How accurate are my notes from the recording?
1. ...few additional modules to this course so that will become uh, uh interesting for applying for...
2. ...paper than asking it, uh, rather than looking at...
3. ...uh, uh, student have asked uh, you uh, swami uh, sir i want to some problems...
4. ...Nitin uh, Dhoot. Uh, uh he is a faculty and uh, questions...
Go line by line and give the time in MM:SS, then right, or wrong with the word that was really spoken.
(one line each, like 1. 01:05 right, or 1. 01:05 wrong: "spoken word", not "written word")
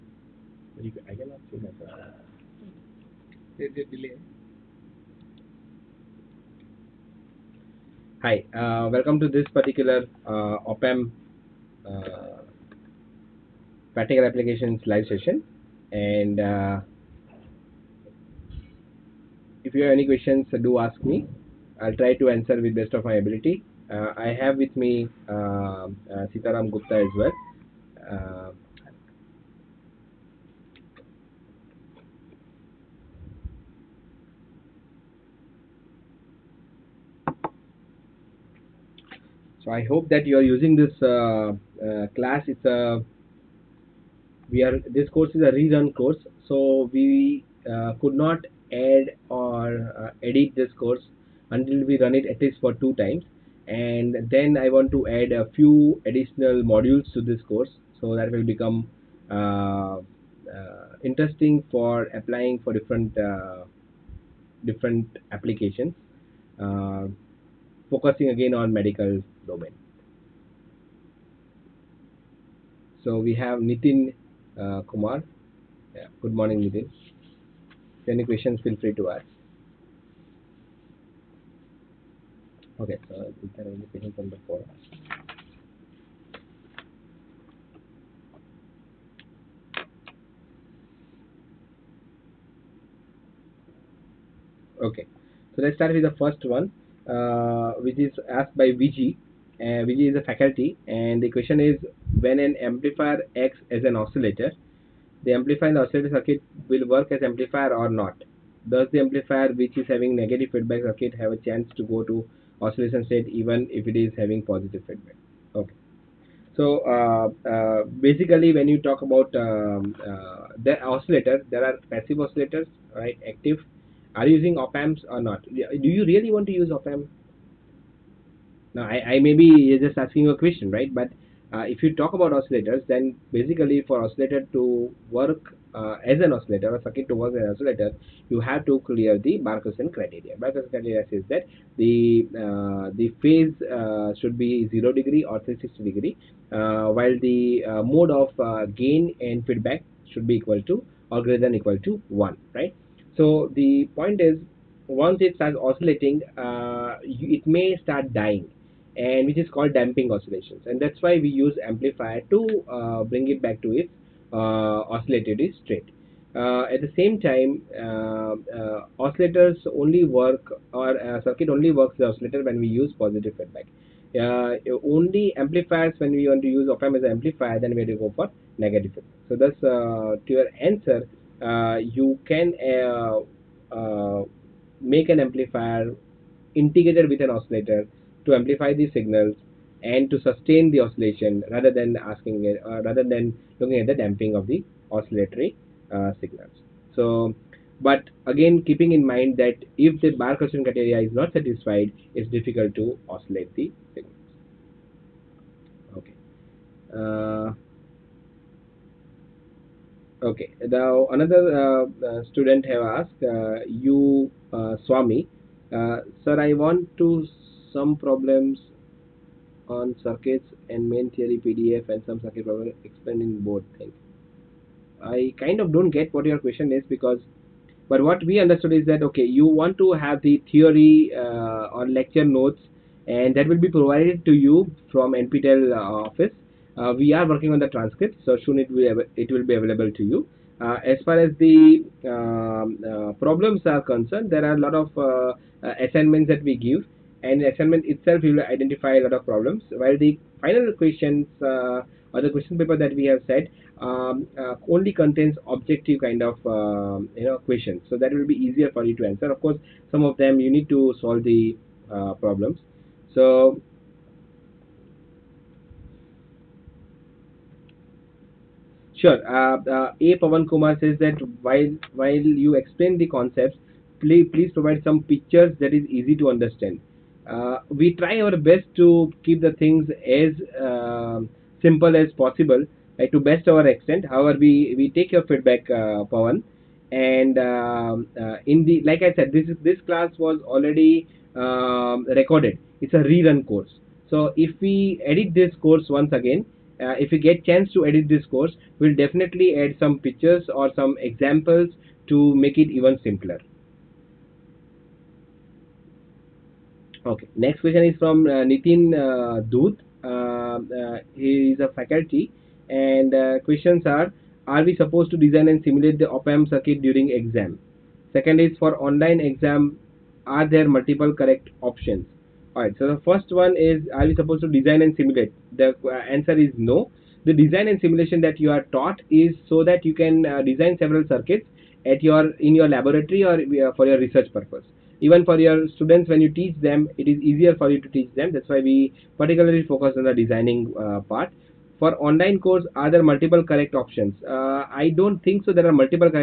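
1. 00:55 right
2. 03:11 wrong: "rather", not "paper"
3. 03:31 right
4. 05:08 right.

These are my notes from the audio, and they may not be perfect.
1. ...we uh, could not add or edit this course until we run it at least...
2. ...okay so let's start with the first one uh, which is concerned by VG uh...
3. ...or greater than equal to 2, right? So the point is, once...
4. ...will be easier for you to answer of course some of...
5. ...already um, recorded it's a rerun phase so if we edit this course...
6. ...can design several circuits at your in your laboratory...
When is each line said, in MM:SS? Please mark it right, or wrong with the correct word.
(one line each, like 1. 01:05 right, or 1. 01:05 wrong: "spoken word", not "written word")
1. 00:46 right
2. 01:34 wrong: "asked", not "concerned"
3. 02:31 wrong: "1", not "2"
4. 04:18 right
5. 04:50 wrong: "course", not "phase"
6. 05:29 right.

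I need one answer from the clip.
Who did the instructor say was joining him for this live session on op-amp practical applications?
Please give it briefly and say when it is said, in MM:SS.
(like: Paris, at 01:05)
Sitaram Gupta, at 00:26.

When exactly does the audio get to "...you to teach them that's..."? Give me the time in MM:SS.
05:37.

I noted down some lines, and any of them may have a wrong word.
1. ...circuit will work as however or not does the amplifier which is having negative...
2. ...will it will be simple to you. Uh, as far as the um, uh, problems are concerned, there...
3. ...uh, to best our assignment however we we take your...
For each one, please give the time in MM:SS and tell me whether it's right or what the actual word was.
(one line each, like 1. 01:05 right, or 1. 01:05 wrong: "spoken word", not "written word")
1. 01:46 wrong: "amplifier", not "however"
2. 03:58 wrong: "available", not "simple"
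3. 04:42 wrong: "extent", not "assignment".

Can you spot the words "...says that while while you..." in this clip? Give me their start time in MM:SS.
04:30.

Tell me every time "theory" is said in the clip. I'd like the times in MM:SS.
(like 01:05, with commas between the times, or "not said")
03:41, 03:50.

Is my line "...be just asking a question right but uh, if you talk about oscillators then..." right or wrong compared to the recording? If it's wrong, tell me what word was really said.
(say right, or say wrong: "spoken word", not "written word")
right.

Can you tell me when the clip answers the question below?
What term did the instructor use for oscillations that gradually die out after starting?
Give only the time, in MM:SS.
02:39.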